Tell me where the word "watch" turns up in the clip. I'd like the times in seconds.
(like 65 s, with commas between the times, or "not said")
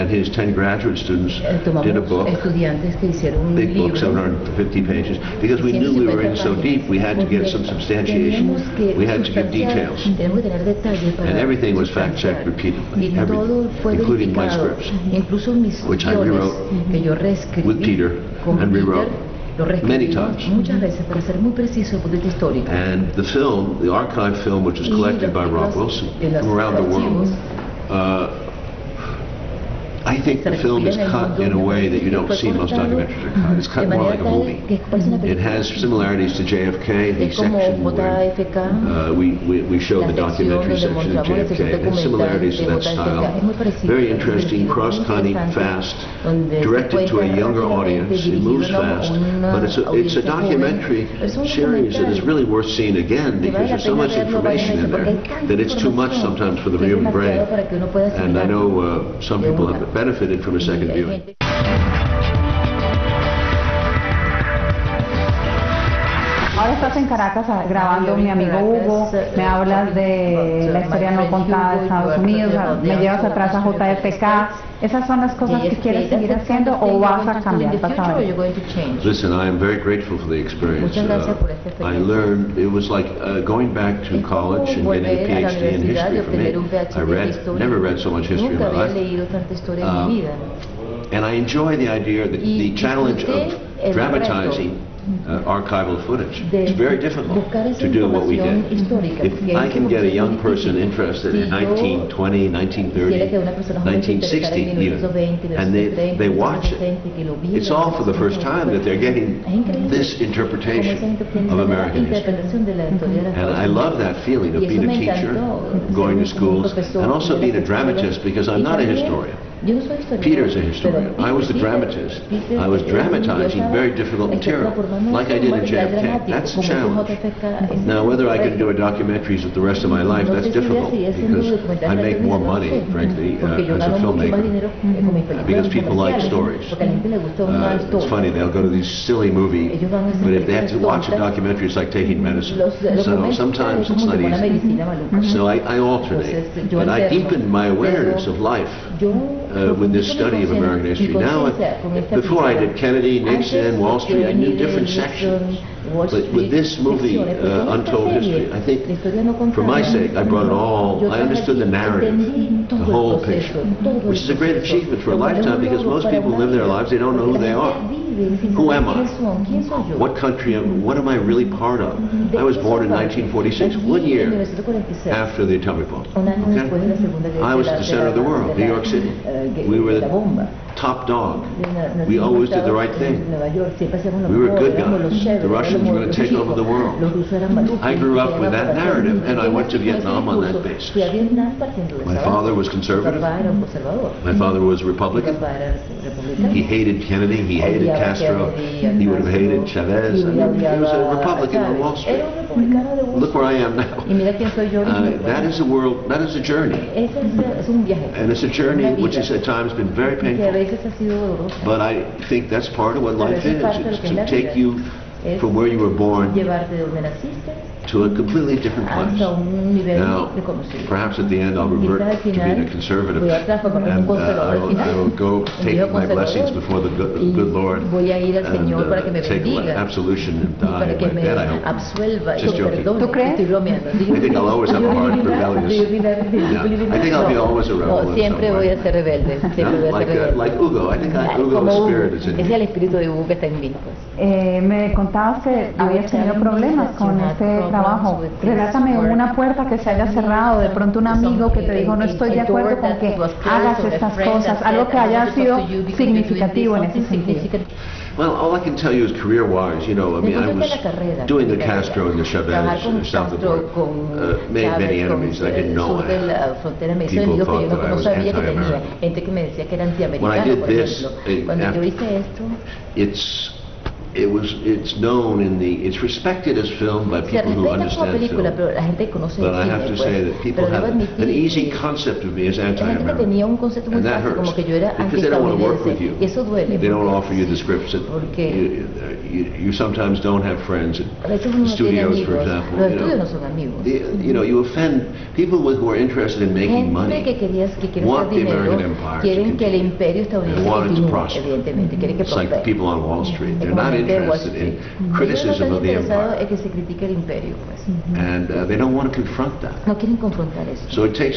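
106 s, 140 s.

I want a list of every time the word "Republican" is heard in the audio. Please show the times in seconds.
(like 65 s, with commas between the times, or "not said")
194 s, 201 s.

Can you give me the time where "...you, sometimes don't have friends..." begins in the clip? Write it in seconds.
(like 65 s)
289 s.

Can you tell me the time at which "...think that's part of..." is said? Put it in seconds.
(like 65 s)
212 s.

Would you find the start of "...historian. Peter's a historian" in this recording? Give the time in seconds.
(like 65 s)
118 s.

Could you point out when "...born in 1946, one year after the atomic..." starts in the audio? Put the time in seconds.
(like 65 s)
172 s.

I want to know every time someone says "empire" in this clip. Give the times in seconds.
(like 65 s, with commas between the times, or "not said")
298 s, 305 s.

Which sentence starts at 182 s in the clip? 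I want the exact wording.
We always did the right thing.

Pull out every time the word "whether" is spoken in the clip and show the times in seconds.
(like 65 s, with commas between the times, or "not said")
128 s.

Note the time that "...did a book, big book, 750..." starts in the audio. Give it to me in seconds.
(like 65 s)
1 s.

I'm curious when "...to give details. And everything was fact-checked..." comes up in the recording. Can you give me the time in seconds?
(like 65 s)
9 s.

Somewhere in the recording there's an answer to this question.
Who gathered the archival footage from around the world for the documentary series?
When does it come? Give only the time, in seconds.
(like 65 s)
25 s.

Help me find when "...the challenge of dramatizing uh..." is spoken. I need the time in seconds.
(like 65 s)
92 s.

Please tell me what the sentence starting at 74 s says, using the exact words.
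¿Esas son las cosas que quieres seguir haciendo o vas a cambiar?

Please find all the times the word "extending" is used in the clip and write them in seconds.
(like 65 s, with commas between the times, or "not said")
not said.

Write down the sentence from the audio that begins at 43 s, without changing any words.
Very interesting, cross-cutting, fast, directed to a younger audience.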